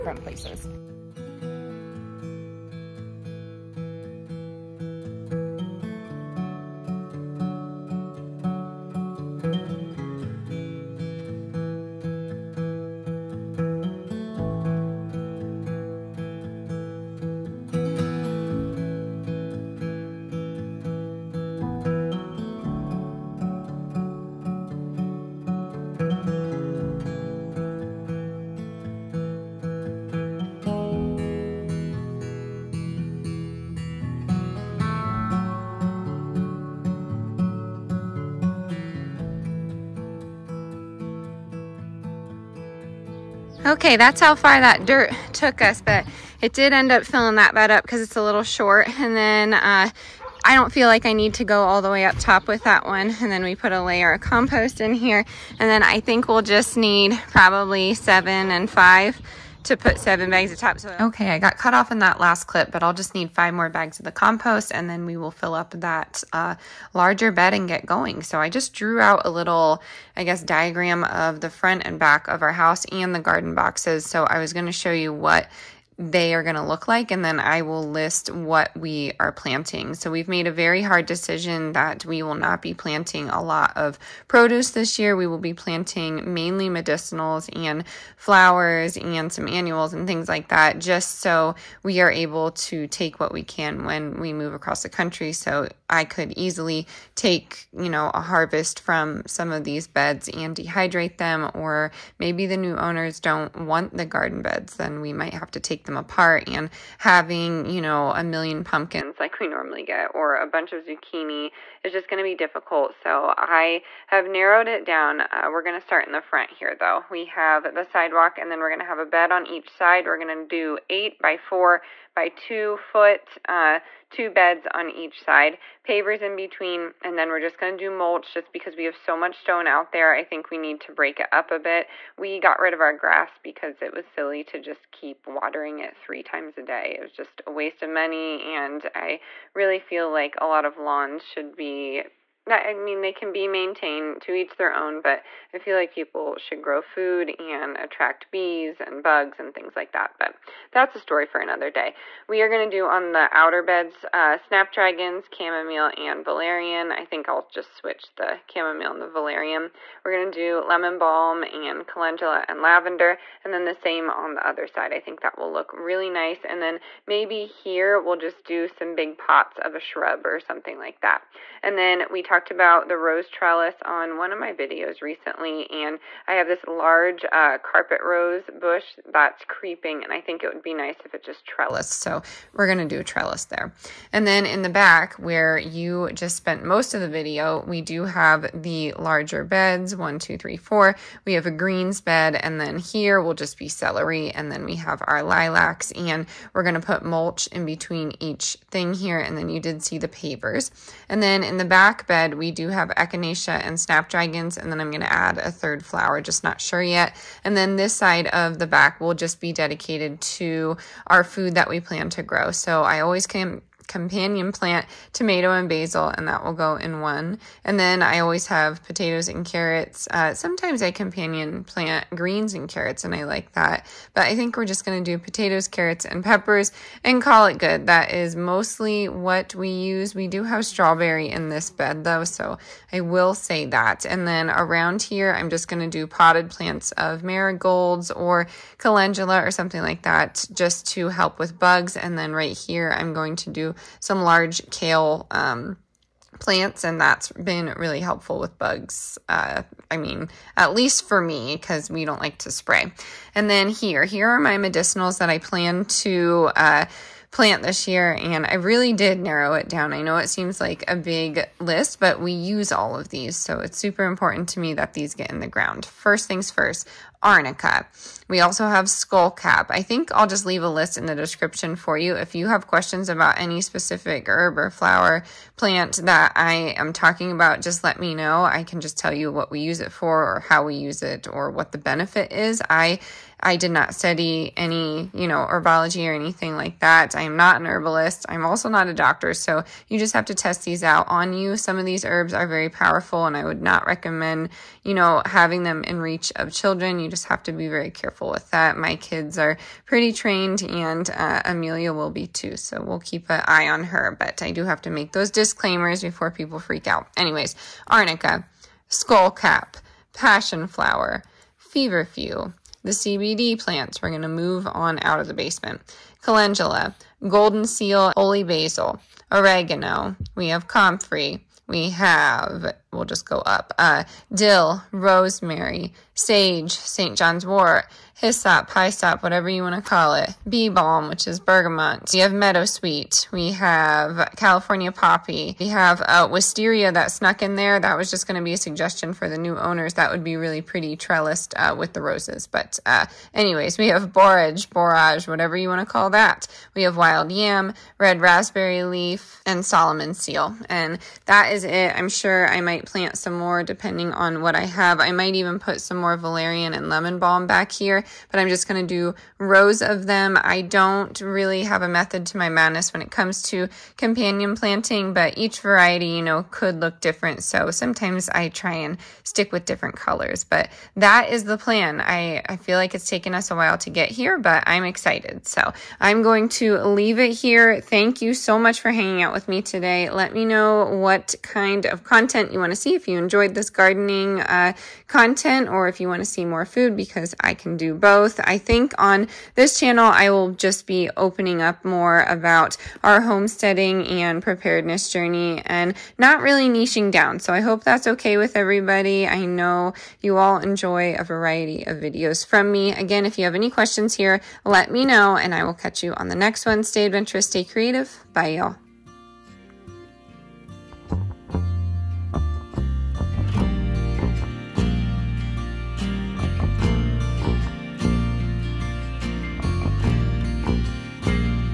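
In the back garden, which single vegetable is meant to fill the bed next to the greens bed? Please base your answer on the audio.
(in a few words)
Celery.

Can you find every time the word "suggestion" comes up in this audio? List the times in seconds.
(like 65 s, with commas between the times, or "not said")
338 s.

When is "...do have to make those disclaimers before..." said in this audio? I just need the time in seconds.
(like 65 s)
304 s.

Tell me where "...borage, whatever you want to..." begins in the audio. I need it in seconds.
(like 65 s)
344 s.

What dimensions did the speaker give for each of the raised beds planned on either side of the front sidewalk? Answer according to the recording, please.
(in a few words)
8 by 4 by 2 feet.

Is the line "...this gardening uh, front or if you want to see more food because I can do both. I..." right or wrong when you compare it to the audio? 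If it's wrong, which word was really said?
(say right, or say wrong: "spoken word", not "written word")
wrong: "content", not "front".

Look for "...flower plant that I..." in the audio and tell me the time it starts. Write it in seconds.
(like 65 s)
274 s.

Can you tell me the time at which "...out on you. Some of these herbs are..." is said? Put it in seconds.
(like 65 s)
290 s.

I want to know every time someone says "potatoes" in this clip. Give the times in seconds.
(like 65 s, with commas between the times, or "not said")
218 s, 225 s.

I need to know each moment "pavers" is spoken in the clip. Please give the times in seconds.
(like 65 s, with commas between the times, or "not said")
125 s, 200 s.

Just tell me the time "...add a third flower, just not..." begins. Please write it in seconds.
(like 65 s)
205 s.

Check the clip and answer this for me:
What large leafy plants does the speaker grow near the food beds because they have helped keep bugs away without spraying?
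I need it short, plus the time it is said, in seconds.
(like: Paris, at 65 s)
Kale, at 244 s.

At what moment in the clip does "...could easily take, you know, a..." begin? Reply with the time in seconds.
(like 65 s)
96 s.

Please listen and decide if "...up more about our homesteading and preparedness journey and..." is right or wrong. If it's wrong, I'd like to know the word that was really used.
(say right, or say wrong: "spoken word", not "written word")
right.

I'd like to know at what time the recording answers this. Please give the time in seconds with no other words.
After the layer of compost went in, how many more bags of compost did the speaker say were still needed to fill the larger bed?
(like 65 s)
63 s.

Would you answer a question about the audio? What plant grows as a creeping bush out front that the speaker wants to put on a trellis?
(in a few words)
Carpet rose.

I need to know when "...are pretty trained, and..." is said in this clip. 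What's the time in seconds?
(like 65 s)
299 s.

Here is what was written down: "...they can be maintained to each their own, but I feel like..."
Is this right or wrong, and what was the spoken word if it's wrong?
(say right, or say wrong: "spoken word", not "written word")
right.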